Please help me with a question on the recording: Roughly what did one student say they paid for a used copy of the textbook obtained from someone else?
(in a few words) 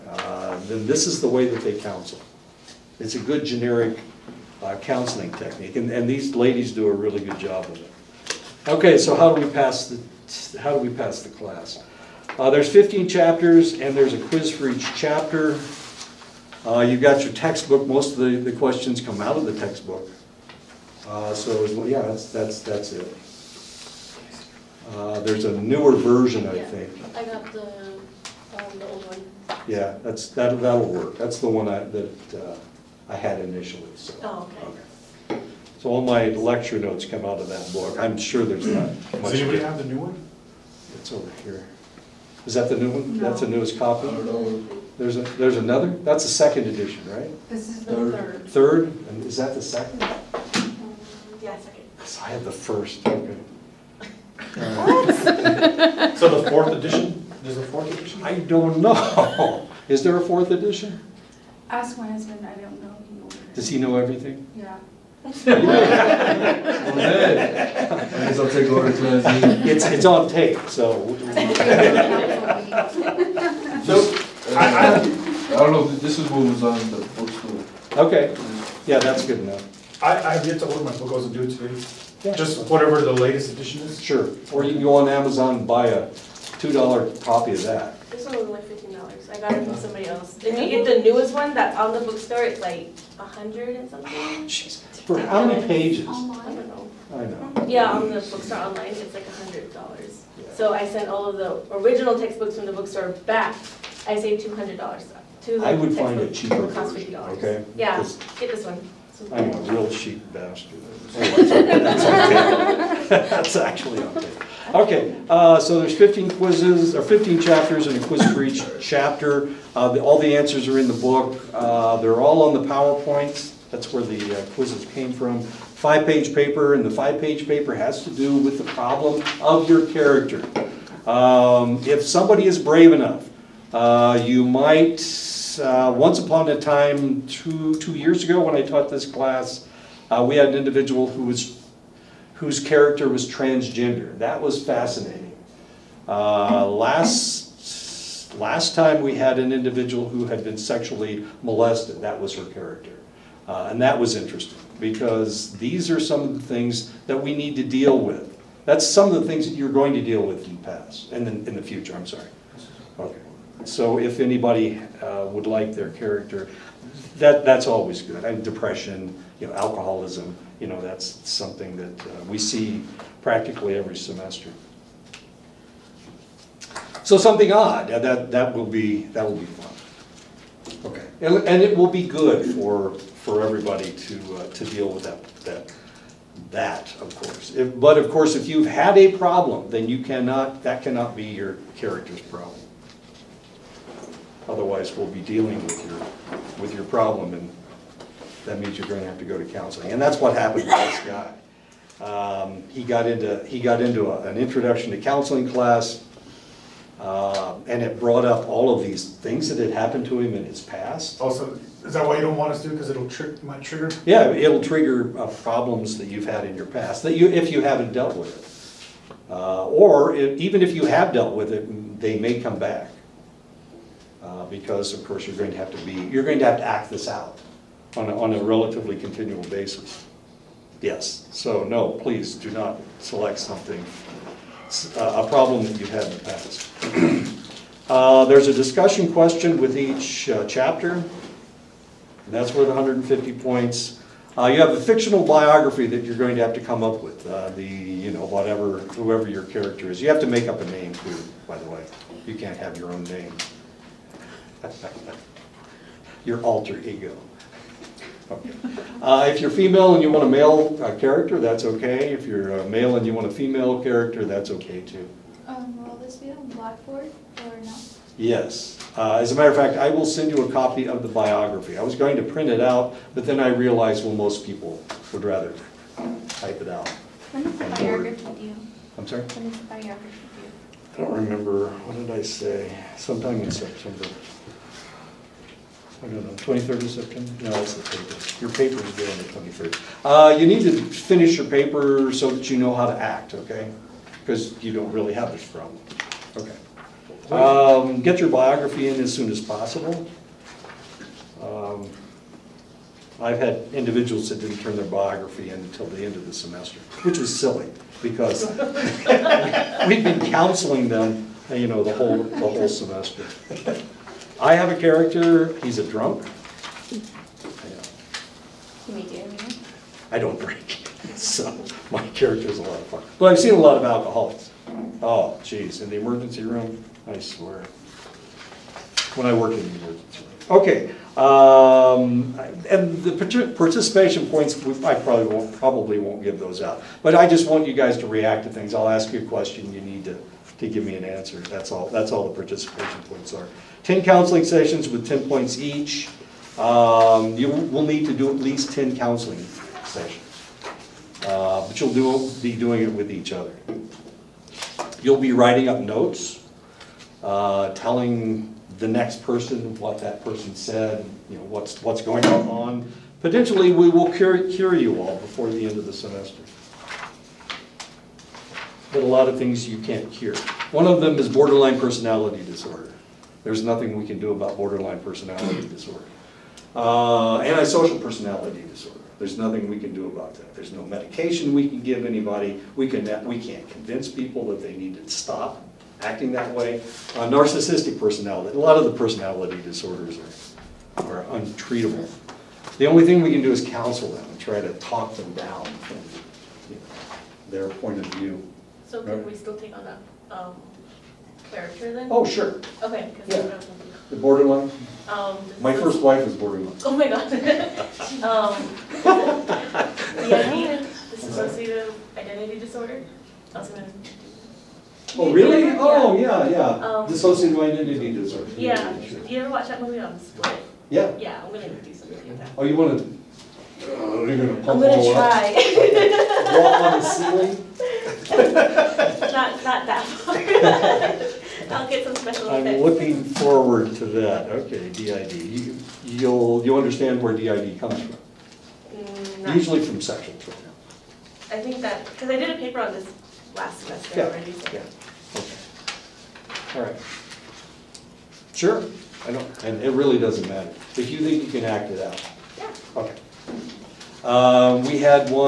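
fifteen dollars.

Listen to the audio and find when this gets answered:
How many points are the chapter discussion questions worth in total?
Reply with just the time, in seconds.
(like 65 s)
242 s.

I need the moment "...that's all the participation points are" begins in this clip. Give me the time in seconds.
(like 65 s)
341 s.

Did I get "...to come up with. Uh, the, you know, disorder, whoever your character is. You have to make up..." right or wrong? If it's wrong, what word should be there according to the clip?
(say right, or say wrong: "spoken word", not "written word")
wrong: "whatever", not "disorder".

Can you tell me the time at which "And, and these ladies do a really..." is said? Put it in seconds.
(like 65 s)
5 s.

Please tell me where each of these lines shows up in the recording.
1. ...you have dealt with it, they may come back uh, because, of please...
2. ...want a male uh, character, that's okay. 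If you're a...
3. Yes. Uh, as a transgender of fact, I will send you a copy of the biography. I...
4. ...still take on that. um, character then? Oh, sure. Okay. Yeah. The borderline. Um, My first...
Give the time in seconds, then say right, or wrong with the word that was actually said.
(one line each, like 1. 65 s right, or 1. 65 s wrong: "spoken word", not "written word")
1. 220 s wrong: "course", not "please"
2. 260 s right
3. 268 s wrong: "matter", not "transgender"
4. 399 s right.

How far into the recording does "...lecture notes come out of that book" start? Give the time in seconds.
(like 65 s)
36 s.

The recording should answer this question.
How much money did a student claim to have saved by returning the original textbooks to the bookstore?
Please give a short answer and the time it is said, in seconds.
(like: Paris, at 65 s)
two hundred dollars, at 104 s.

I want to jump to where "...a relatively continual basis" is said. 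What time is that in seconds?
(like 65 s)
228 s.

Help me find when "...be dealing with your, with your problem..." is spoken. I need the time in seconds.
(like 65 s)
195 s.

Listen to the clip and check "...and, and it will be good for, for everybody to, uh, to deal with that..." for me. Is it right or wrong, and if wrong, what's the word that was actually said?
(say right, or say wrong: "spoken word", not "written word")
right.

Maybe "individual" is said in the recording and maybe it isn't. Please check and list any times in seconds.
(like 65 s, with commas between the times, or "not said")
140 s, 149 s, 303 s.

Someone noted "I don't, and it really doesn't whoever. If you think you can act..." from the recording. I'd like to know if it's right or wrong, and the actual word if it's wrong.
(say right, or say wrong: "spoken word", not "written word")
wrong: "matter", not "whoever".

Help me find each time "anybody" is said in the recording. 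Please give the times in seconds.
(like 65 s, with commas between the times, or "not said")
39 s, 164 s, 382 s.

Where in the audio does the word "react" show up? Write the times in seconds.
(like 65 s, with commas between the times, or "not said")
338 s.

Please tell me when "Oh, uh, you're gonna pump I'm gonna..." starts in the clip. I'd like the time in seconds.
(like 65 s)
423 s.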